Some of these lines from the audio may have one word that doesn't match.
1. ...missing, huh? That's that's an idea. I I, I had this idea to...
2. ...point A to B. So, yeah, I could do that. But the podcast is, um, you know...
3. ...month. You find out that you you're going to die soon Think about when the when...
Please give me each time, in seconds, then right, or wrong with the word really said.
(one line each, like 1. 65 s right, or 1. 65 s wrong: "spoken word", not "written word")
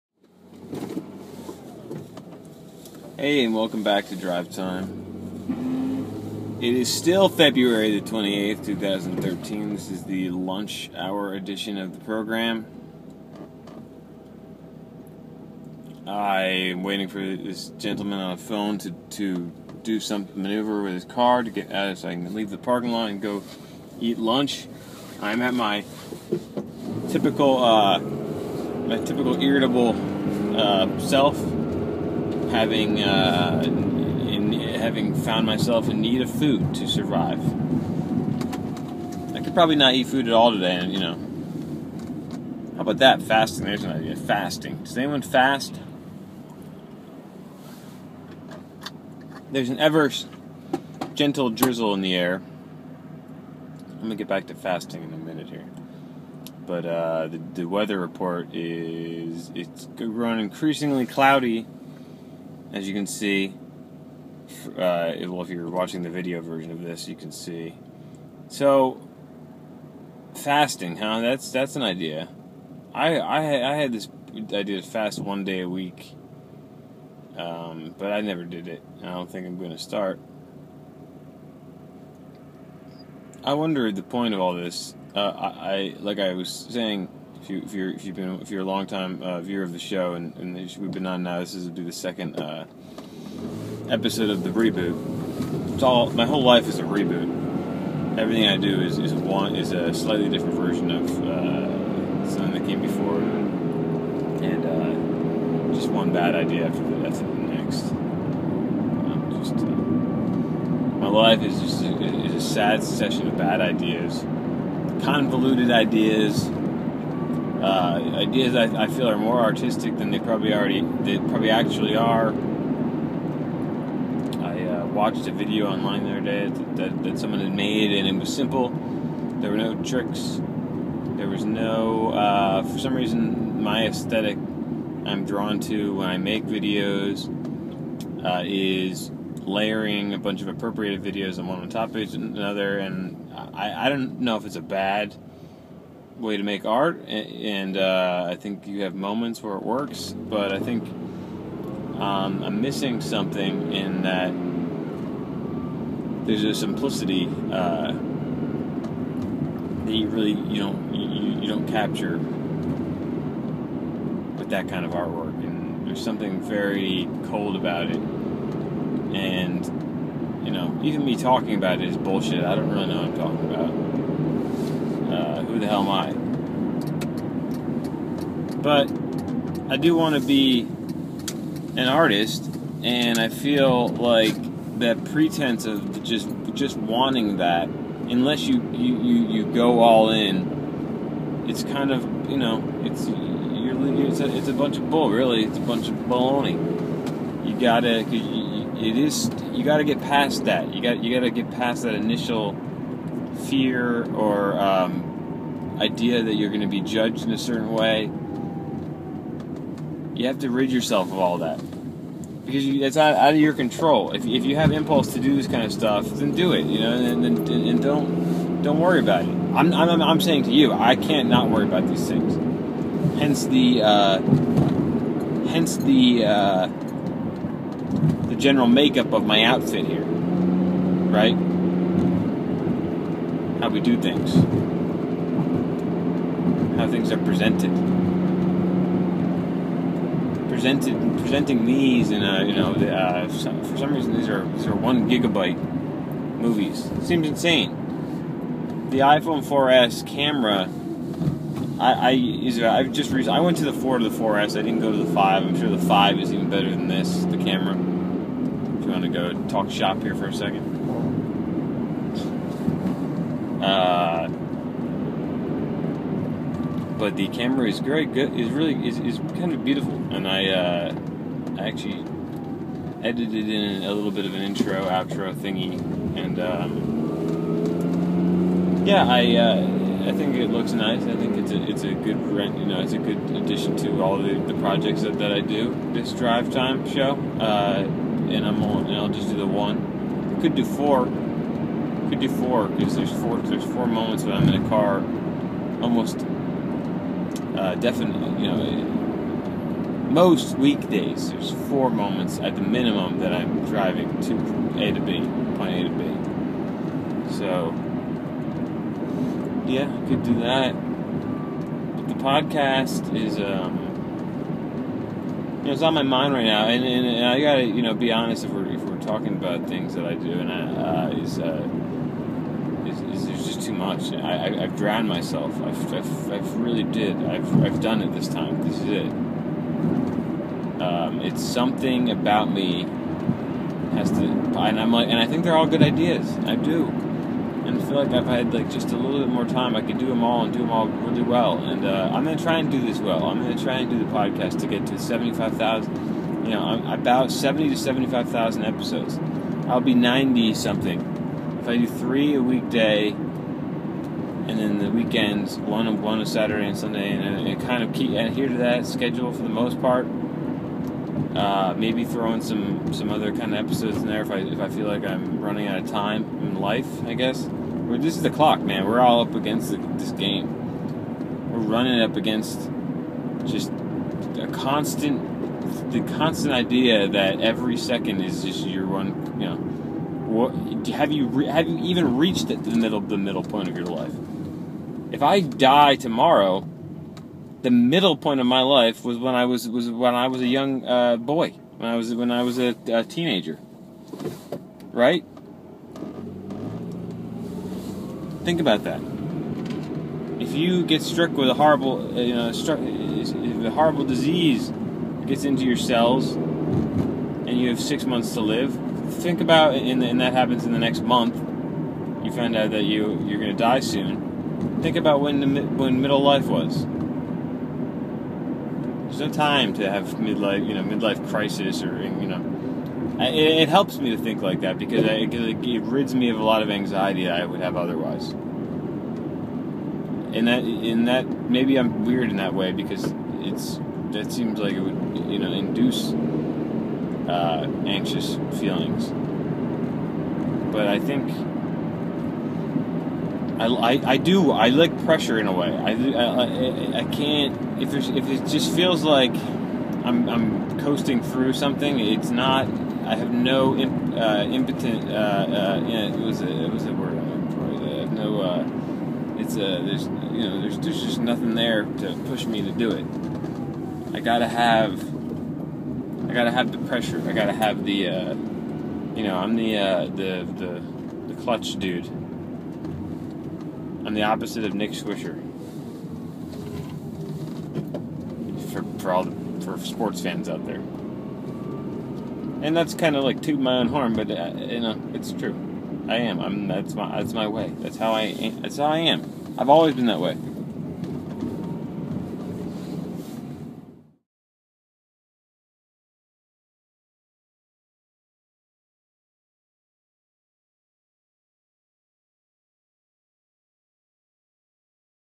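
1. 70 s wrong: "fasting", not "missing"
2. 305 s right
3. 411 s right.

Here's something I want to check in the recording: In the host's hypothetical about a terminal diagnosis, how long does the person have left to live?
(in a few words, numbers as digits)
6 months.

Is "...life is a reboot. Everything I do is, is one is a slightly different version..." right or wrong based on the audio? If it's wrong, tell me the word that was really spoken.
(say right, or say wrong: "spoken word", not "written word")
right.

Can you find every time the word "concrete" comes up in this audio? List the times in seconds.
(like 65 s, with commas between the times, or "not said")
not said.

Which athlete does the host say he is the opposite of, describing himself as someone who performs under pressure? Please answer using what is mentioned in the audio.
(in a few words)
Nick Swisher.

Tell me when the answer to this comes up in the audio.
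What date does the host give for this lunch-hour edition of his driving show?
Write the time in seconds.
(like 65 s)
7 s.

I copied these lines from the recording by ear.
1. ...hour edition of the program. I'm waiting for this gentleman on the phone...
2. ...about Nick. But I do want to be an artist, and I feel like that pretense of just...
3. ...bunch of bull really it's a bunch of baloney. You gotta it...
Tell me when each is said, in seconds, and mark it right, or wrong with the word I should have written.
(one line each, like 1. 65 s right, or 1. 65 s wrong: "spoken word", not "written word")
1. 10 s right
2. 173 s wrong: "DLMI", not "Nick"
3. 194 s right.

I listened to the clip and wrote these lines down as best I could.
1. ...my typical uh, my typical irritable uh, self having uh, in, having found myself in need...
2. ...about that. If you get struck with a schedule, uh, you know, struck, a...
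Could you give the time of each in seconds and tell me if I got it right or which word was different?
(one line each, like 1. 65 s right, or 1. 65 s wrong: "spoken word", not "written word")
1. 25 s right
2. 398 s wrong: "horrible", not "schedule".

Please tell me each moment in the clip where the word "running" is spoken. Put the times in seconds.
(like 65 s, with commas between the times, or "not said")
365 s, 371 s.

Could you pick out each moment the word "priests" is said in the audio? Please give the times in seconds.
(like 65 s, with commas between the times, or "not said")
not said.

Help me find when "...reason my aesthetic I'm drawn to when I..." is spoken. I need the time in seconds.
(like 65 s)
132 s.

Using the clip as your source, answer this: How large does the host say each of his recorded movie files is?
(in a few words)
1 gigabyte.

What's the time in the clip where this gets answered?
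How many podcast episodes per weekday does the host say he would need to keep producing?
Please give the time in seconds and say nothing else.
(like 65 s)
351 s.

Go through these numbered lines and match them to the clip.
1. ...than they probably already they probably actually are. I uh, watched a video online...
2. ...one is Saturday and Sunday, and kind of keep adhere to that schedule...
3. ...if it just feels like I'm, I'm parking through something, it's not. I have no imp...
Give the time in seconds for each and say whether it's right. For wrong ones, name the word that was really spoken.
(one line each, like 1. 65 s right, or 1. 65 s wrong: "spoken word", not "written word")
1. 119 s right
2. 356 s right
3. 448 s wrong: "coasting", not "parking".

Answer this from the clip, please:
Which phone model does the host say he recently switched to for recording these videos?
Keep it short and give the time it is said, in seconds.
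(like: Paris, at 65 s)
iPhone 4S, at 248 s.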